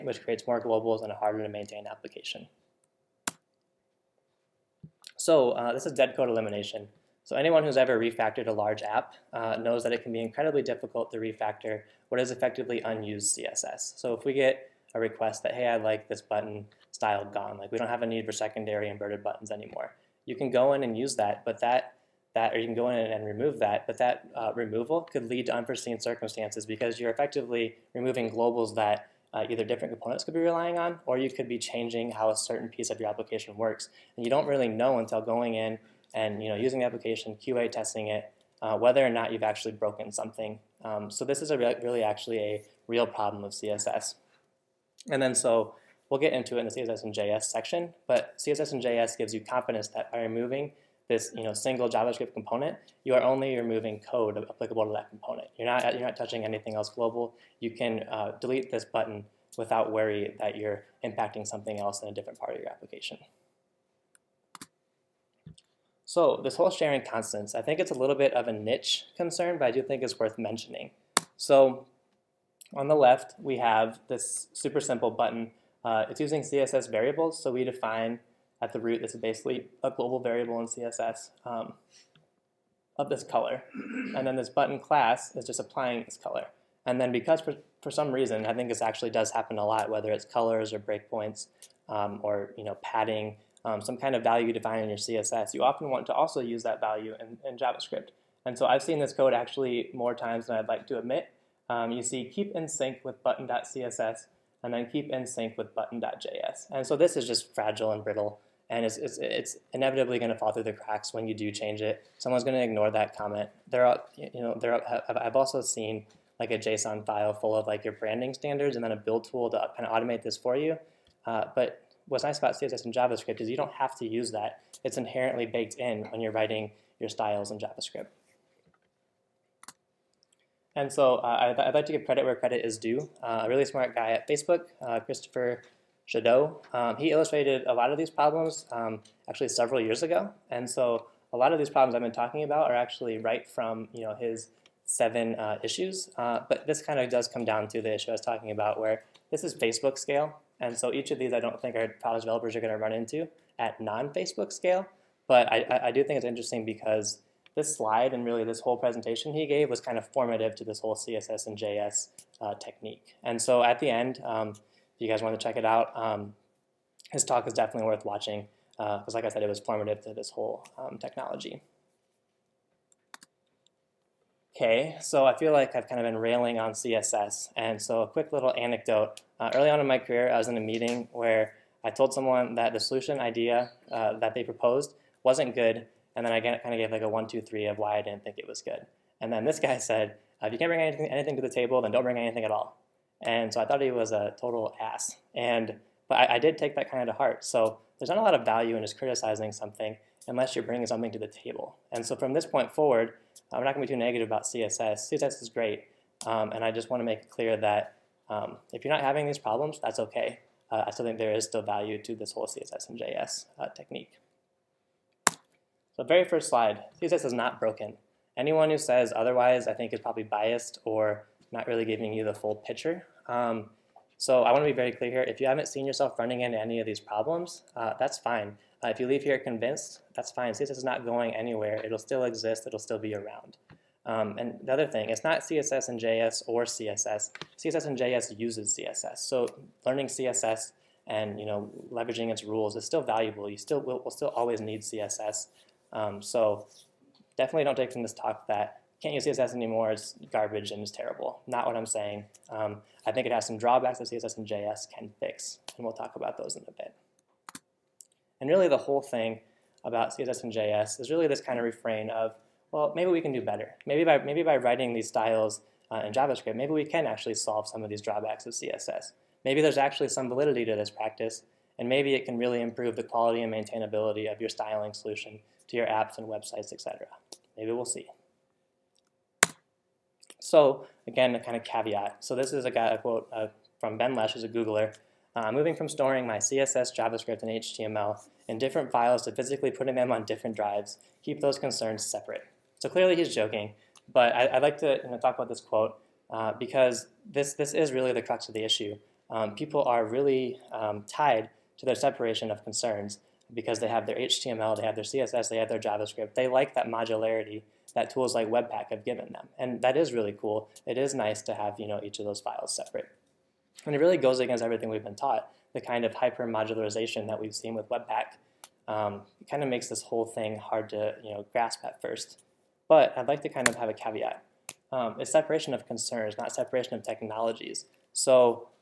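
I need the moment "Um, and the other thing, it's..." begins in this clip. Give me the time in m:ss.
3:54.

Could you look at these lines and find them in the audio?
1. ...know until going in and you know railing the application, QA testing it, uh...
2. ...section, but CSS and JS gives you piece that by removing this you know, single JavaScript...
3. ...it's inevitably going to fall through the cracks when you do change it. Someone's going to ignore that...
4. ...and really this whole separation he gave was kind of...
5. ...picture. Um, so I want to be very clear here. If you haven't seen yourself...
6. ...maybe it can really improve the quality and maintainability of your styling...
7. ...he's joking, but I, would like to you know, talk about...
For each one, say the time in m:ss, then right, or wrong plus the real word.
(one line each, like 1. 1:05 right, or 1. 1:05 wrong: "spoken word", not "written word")
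1. 0:34 wrong: "using", not "railing"
2. 0:47 wrong: "confidence", not "piece"
3. 1:49 right
4. 2:38 wrong: "presentation", not "separation"
5. 3:42 right
6. 4:31 right
7. 4:53 right.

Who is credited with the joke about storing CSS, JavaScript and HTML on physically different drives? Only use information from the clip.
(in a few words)
Ben Lesh.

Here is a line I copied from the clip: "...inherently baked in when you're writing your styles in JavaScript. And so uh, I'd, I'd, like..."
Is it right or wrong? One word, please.
right.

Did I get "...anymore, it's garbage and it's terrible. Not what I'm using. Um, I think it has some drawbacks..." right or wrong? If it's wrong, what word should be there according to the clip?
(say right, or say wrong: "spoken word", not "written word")
wrong: "saying", not "using".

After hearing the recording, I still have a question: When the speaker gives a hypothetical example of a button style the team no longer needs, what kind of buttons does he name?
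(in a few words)
secondary inverted buttons.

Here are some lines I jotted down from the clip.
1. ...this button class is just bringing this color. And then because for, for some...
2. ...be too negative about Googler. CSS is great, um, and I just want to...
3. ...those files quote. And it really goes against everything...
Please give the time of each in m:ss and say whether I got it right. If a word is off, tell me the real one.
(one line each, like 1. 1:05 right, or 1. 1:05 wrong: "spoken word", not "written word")
1. 1:24 wrong: "applying", not "bringing"
2. 3:23 wrong: "CSS", not "Googler"
3. 5:12 wrong: "separate", not "quote".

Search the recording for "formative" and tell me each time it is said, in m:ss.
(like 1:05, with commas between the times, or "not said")
2:40, 2:49.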